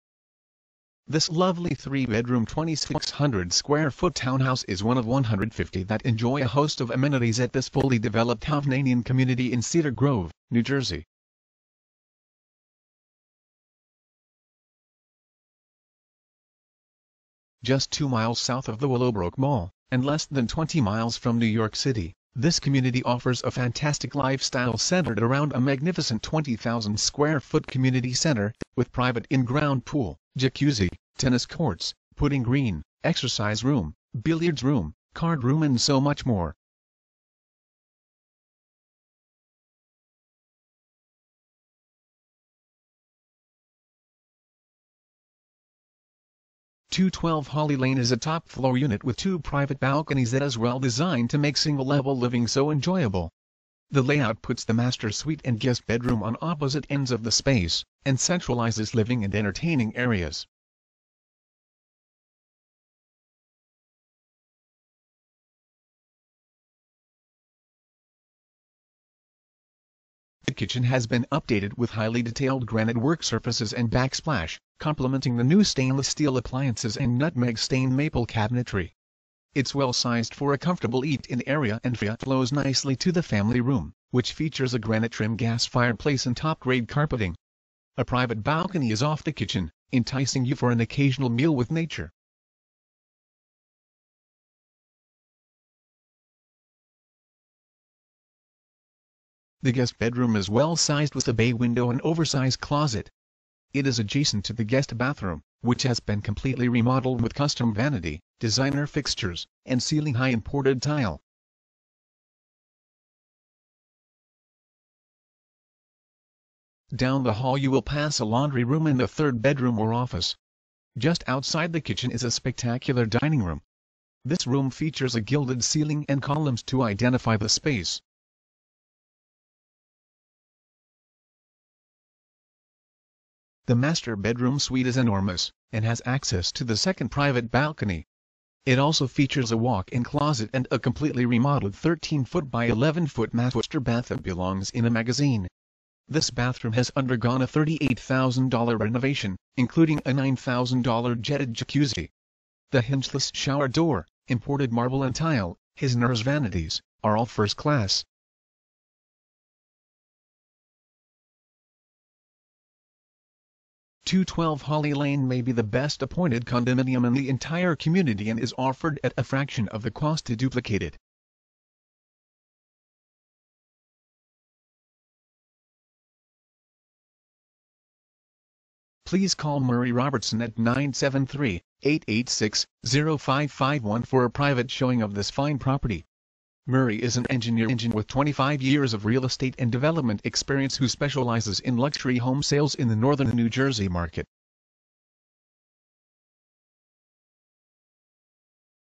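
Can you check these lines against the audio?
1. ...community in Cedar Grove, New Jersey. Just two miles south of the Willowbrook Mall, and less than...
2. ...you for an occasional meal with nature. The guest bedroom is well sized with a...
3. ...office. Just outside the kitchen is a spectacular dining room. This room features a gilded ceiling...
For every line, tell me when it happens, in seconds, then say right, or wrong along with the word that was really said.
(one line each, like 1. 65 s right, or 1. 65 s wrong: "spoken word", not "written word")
1. 9 s right
2. 90 s right
3. 119 s right.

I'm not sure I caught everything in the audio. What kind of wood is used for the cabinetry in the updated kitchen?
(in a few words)
Maple.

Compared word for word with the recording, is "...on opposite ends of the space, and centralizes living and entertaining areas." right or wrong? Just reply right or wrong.
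right.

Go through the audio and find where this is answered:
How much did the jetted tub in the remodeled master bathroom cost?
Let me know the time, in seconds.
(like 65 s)
150 s.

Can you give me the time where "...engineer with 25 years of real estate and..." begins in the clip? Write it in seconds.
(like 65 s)
187 s.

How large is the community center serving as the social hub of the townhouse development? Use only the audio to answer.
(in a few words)
20,000 square feet.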